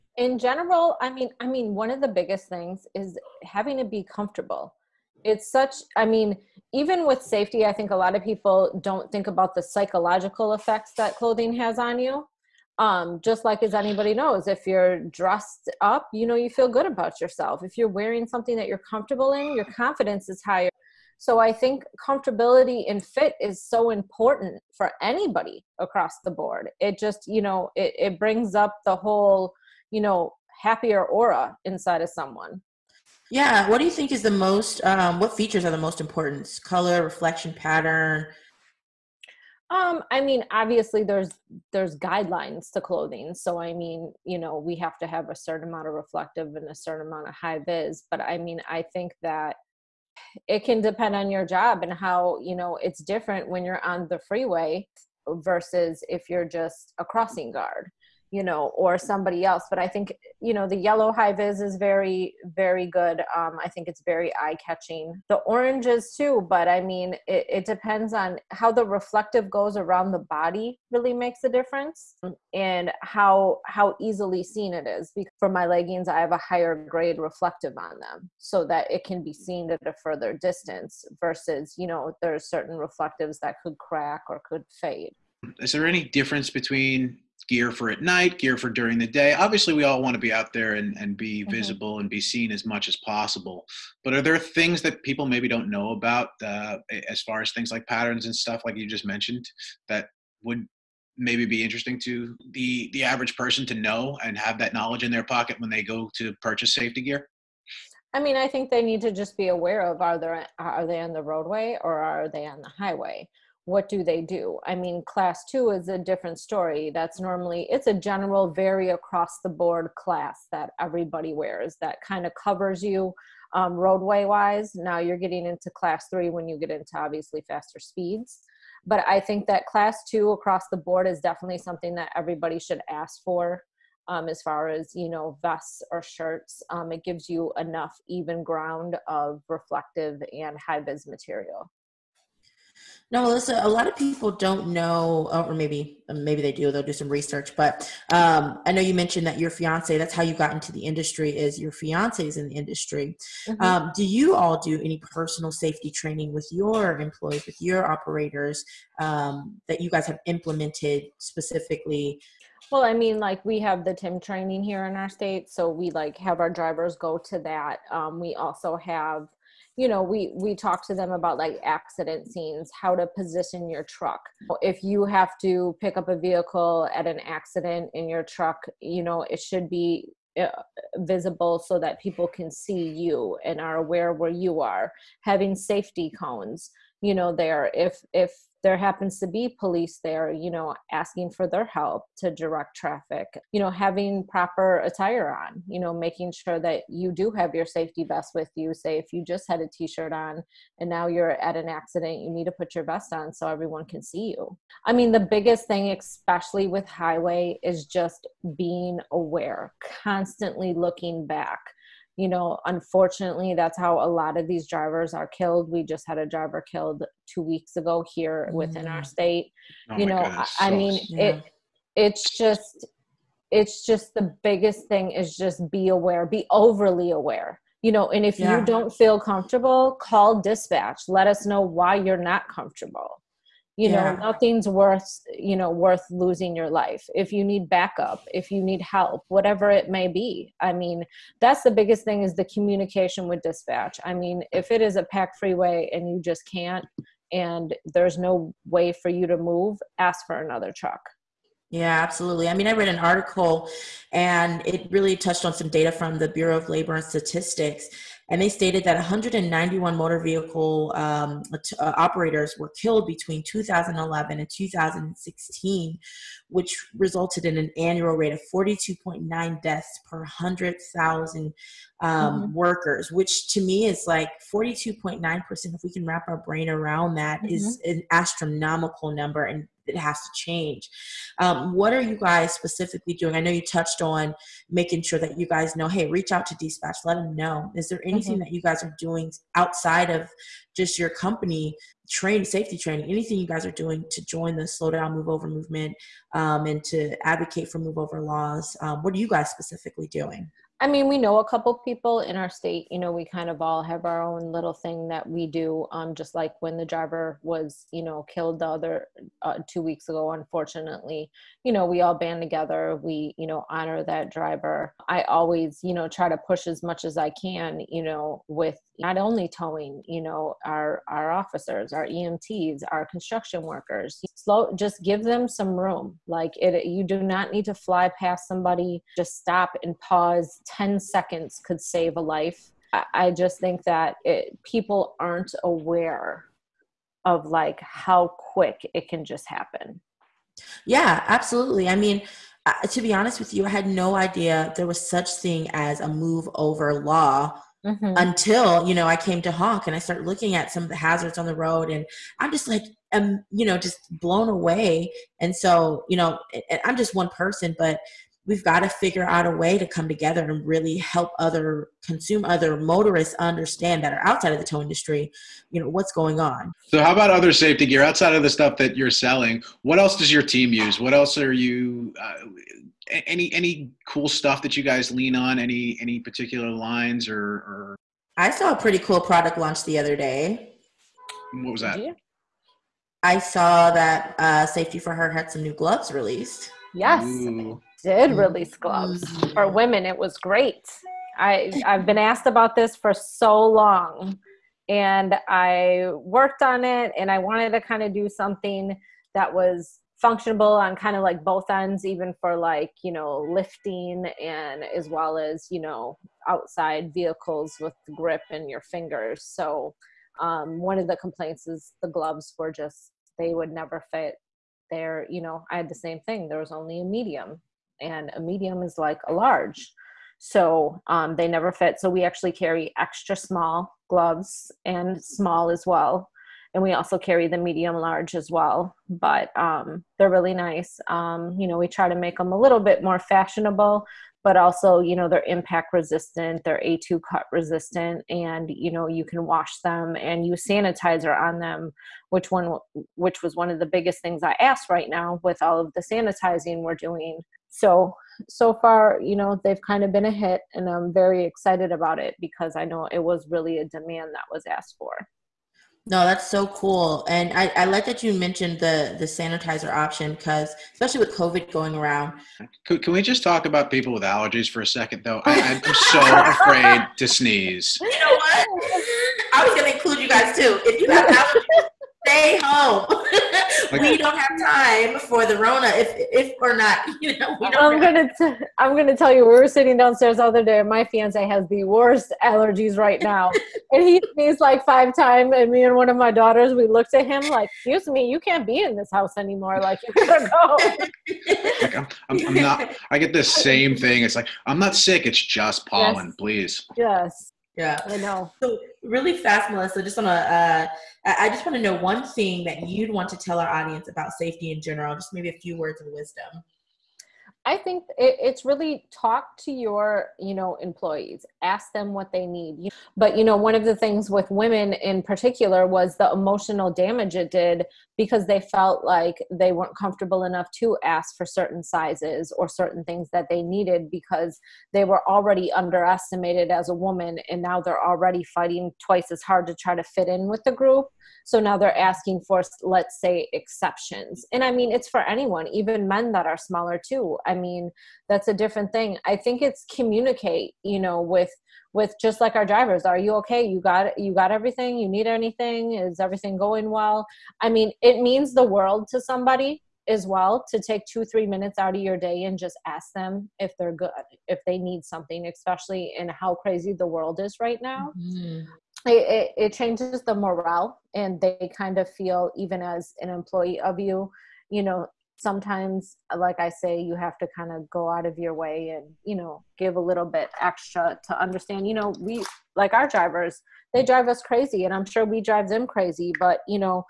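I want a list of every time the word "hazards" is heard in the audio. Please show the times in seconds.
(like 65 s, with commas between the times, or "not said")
350 s.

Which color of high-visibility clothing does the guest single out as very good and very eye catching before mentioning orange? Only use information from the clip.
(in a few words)
Yellow.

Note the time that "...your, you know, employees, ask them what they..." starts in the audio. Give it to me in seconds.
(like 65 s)
509 s.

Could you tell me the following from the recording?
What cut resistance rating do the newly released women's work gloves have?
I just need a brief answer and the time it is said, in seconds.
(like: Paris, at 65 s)
A2, at 436 s.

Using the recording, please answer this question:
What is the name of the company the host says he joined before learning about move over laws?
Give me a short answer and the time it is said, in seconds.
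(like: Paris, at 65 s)
Honk, at 349 s.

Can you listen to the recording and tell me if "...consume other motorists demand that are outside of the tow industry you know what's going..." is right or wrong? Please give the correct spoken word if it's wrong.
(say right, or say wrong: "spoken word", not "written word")
wrong: "understand", not "demand".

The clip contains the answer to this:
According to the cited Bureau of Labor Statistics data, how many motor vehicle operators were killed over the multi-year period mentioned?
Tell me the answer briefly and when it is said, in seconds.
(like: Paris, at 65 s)
191, at 258 s.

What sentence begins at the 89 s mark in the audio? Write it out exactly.
Obviously, we all want to be out there and, and be mm-hmm.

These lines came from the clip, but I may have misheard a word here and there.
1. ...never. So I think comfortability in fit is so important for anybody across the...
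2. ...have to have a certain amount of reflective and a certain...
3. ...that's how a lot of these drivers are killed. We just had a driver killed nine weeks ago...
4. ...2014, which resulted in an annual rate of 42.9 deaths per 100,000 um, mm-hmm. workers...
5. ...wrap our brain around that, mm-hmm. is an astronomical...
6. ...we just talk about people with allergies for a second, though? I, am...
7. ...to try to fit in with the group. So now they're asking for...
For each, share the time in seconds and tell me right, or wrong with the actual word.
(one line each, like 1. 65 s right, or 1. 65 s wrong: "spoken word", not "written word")
1. 20 s wrong: "higher", not "never"
2. 44 s right
3. 213 s wrong: "two", not "nine"
4. 264 s wrong: "2016", not "2014"
5. 276 s right
6. 463 s right
7. 529 s right.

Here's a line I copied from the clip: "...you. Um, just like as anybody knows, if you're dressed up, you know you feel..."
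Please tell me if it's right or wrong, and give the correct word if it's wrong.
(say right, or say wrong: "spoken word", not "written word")
right.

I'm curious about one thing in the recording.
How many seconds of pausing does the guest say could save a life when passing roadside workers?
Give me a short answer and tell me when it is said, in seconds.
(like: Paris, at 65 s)
10 seconds, at 330 s.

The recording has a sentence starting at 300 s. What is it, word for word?
I mean, we know a couple people in our state.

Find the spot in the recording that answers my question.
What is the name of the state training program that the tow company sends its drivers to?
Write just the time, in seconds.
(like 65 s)
163 s.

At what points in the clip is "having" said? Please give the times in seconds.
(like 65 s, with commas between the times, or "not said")
3 s, 185 s, 193 s.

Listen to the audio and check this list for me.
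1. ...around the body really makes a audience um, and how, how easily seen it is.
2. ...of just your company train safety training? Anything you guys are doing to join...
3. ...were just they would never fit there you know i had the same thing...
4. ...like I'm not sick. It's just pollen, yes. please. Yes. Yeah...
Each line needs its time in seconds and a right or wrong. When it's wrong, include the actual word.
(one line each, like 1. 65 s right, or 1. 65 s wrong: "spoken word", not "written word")
1. 69 s wrong: "difference", not "audience"
2. 290 s right
3. 412 s right
4. 494 s right.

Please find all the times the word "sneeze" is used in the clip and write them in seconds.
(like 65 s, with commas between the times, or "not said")
467 s, 484 s.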